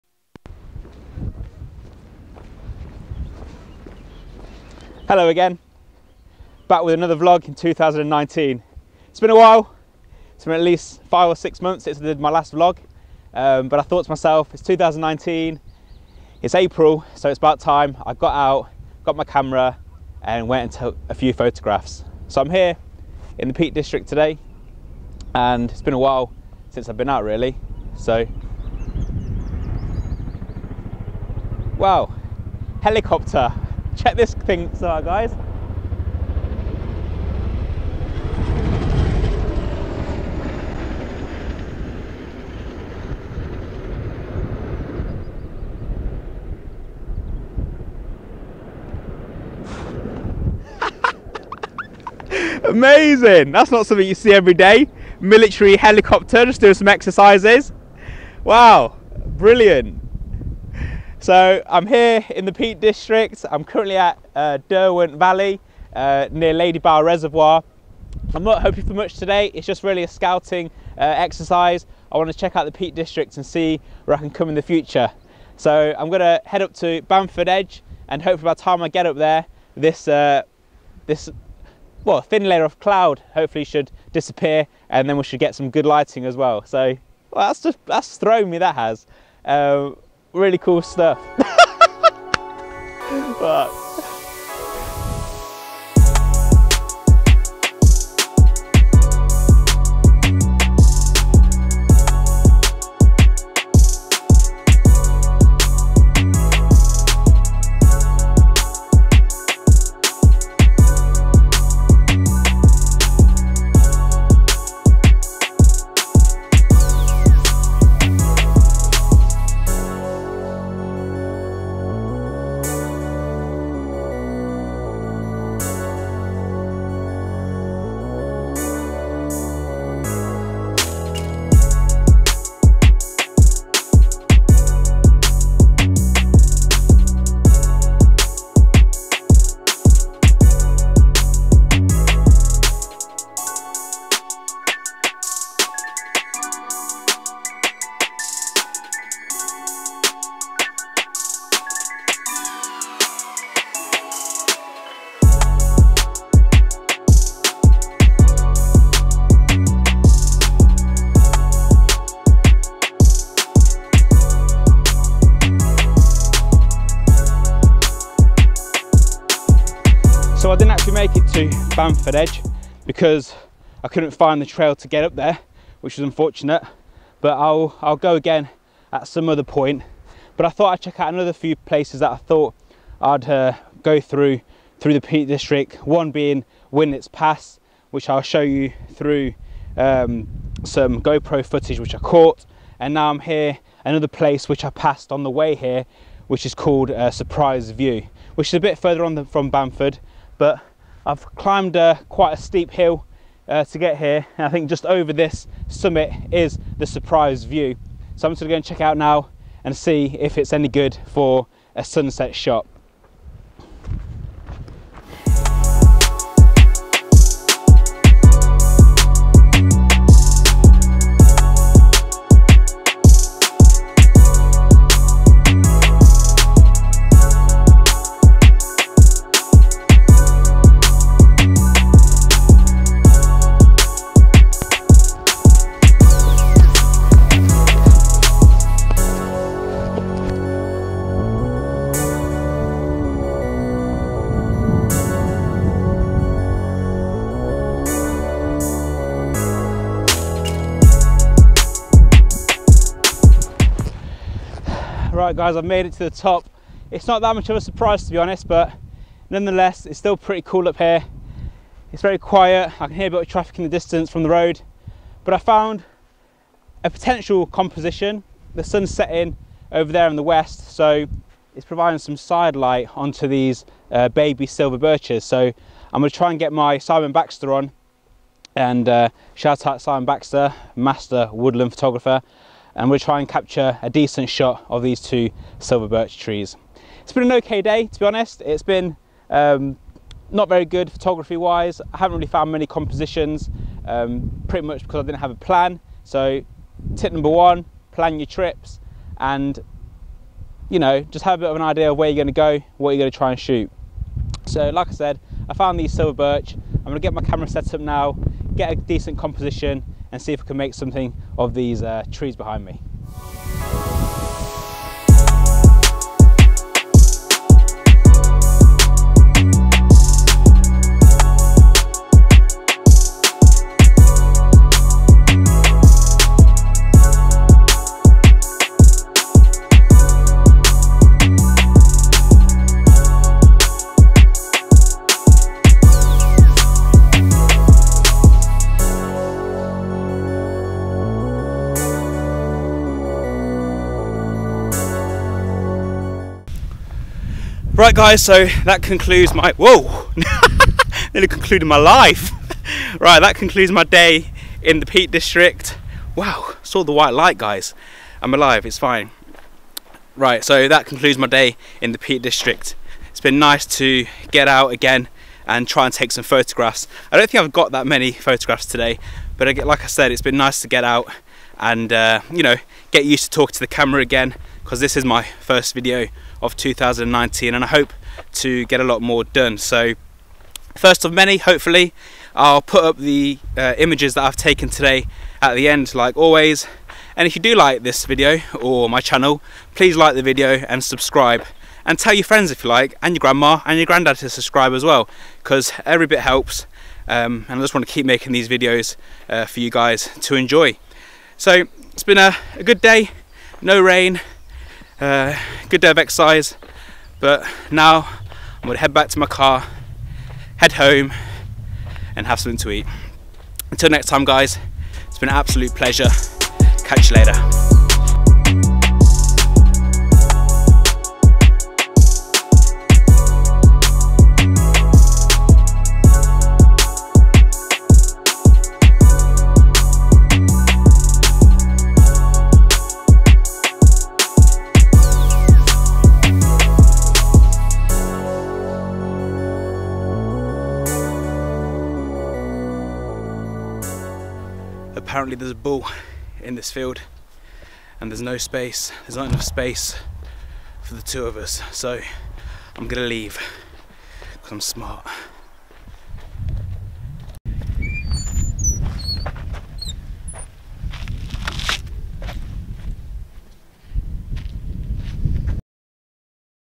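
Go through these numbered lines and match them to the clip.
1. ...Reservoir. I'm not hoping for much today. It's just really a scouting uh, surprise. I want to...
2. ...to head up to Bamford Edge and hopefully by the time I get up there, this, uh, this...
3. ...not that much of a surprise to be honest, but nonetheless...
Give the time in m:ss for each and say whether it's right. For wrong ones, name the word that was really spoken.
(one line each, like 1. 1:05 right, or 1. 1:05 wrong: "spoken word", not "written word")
1. 1:07 wrong: "exercise", not "surprise"
2. 1:16 right
3. 4:17 right.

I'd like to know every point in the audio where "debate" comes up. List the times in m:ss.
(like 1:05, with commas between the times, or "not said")
not said.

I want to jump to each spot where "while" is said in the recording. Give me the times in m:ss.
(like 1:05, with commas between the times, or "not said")
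0:09, 0:25.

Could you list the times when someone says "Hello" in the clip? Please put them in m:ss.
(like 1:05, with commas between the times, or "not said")
0:05.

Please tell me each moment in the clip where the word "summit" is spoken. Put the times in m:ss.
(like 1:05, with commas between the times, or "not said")
3:25.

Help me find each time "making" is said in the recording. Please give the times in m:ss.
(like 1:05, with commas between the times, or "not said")
6:38.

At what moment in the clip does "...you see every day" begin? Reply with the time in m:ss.
0:54.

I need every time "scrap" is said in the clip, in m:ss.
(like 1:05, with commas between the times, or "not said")
not said.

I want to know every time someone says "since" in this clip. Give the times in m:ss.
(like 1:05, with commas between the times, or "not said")
0:11, 0:26.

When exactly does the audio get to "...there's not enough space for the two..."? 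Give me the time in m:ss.
7:29.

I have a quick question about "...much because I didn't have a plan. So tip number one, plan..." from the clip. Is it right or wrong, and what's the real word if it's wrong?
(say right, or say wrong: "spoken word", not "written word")
right.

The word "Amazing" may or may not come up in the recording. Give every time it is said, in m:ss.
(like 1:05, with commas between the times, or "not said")
0:52.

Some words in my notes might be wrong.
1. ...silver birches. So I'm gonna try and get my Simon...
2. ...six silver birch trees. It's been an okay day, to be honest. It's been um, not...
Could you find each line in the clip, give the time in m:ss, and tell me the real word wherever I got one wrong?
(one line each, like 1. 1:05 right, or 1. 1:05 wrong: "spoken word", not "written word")
1. 4:34 right
2. 4:44 wrong: "two", not "six".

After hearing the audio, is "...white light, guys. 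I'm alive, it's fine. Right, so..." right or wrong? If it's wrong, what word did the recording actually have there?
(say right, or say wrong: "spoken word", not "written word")
right.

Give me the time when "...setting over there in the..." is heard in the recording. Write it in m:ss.
4:28.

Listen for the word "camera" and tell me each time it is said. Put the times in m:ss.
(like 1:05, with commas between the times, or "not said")
0:19, 5:07, 6:13.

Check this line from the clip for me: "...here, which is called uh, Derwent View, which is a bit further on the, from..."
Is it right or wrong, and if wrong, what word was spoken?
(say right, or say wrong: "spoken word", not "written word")
wrong: "Surprise", not "Derwent".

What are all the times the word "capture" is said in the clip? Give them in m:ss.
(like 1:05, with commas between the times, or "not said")
4:43.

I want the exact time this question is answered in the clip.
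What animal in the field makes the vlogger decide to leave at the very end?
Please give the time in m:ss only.
7:25.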